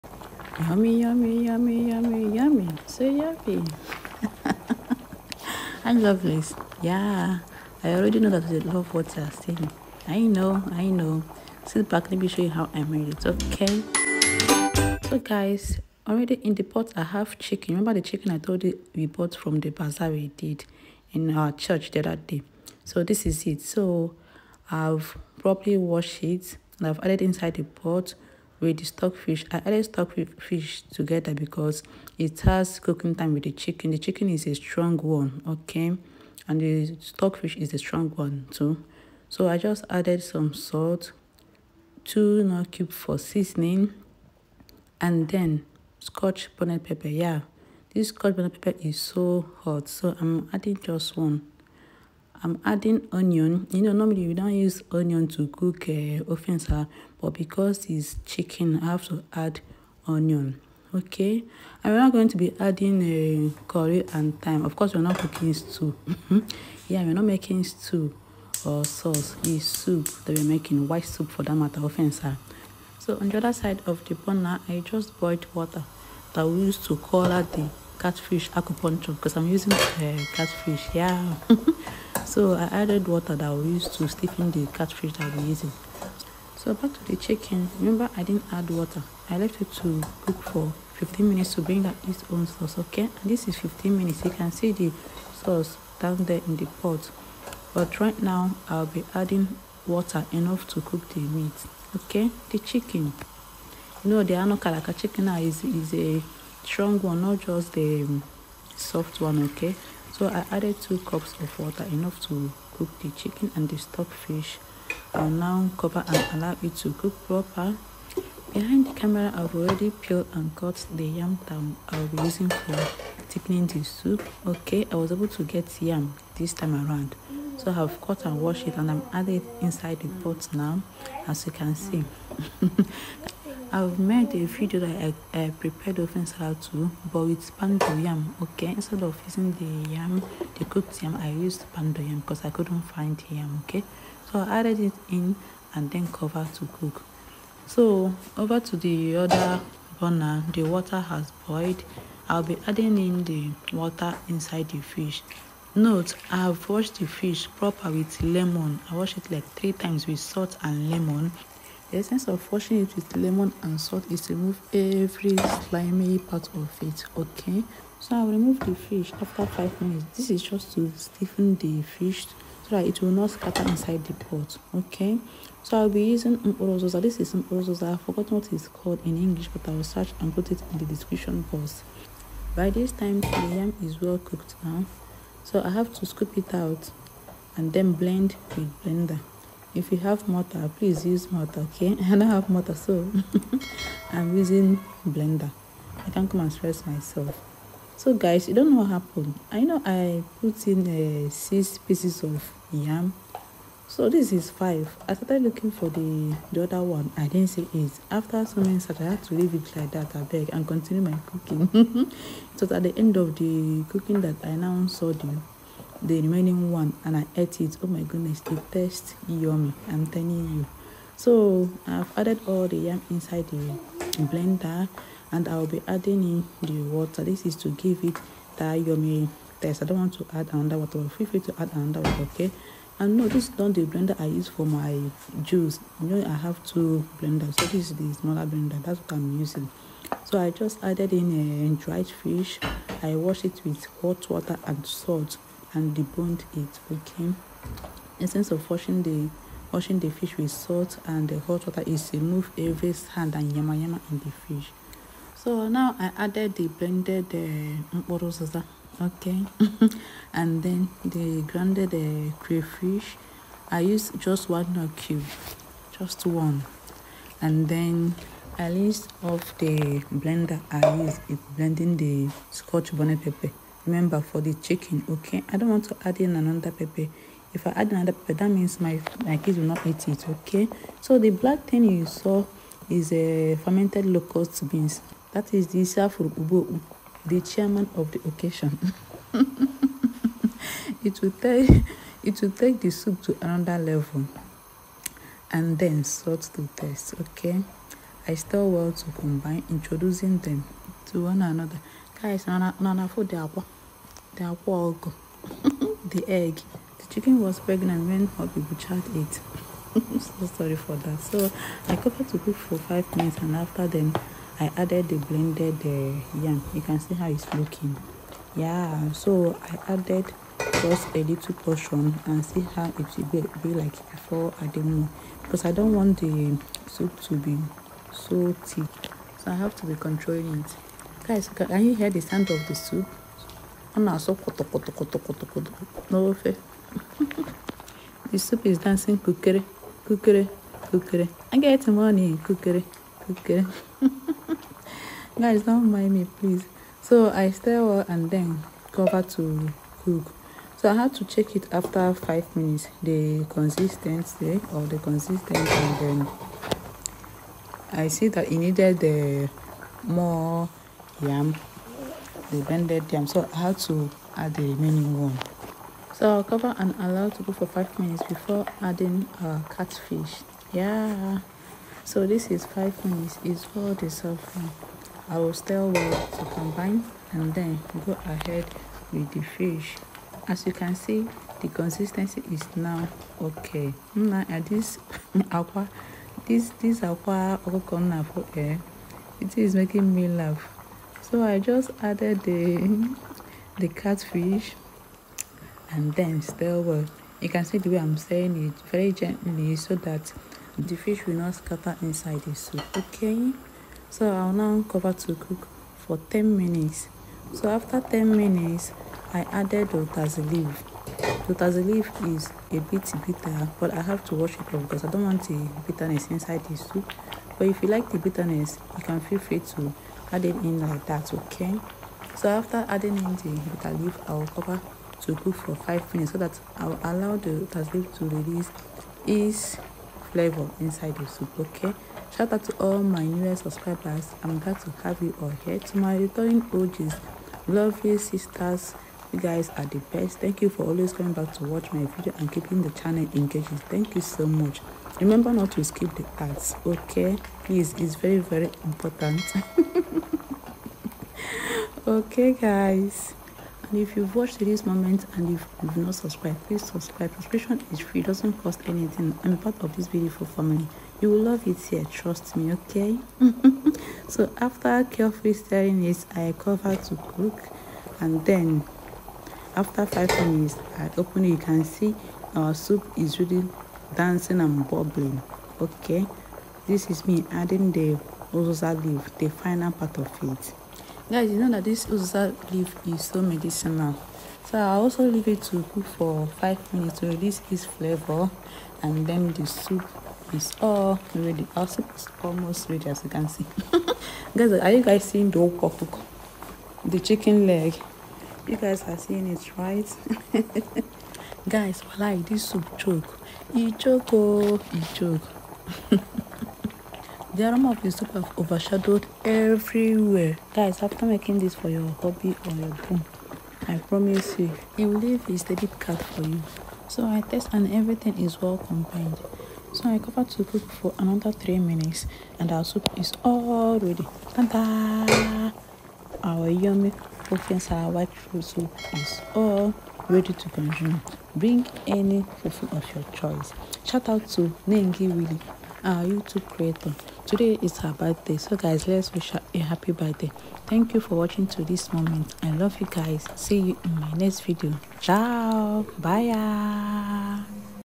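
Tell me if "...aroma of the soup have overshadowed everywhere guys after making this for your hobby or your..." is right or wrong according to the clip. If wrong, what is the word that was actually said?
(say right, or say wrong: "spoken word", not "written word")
right.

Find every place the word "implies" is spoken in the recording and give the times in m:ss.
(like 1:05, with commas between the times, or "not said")
not said.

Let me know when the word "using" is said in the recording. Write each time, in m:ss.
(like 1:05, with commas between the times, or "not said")
1:19, 1:25, 2:02, 2:19, 2:56, 3:14, 3:59.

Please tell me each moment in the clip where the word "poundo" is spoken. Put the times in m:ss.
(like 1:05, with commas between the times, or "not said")
2:17, 2:21.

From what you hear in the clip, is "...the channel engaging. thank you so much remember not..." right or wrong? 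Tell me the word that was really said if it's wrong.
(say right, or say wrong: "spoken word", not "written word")
right.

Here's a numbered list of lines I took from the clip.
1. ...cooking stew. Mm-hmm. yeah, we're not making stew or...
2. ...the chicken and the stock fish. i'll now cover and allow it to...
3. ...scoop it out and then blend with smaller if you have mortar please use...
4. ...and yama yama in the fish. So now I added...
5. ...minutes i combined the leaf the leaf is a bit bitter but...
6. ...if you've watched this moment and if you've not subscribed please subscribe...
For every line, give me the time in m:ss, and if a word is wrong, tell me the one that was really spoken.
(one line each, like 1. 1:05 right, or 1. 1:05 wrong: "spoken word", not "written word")
1. 1:05 right
2. 1:52 right
3. 3:06 wrong: "blender", not "smaller"
4. 4:13 right
5. 6:48 wrong: "added", not "combined"
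6. 7:34 right.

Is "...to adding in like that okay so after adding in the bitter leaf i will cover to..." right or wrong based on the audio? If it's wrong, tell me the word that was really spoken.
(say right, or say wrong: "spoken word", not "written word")
right.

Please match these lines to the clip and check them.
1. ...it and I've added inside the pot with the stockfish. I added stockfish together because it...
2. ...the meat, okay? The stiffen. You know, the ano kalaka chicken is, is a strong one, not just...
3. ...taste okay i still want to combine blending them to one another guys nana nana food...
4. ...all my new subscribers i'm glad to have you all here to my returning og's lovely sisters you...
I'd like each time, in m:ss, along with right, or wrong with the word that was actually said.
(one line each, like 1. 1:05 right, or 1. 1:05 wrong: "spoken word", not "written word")
1. 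0:26 right
2. 1:41 wrong: "chicken", not "stiffen"
3. 4:56 wrong: "introducing", not "blending"
4. 7:12 right.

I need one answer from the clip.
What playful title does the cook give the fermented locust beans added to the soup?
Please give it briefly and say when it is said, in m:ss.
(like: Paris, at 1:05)
The chairman of the occasion, at 4:47.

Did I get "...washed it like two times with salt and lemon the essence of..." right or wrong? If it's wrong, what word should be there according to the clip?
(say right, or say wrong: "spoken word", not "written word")
wrong: "three", not "two".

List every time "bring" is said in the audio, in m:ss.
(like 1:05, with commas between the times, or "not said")
1:31, 8:51.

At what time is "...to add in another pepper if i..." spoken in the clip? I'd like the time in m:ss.
4:35.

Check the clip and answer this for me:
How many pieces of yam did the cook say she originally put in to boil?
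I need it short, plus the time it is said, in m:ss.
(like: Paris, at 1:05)
6, at 3:21.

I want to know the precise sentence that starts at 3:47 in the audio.
This is to give it that yummy taste.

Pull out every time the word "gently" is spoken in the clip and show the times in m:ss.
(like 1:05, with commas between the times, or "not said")
6:39.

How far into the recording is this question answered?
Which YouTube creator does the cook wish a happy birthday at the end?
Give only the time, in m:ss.
8:54.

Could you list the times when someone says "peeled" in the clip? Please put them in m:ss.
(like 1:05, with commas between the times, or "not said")
2:00.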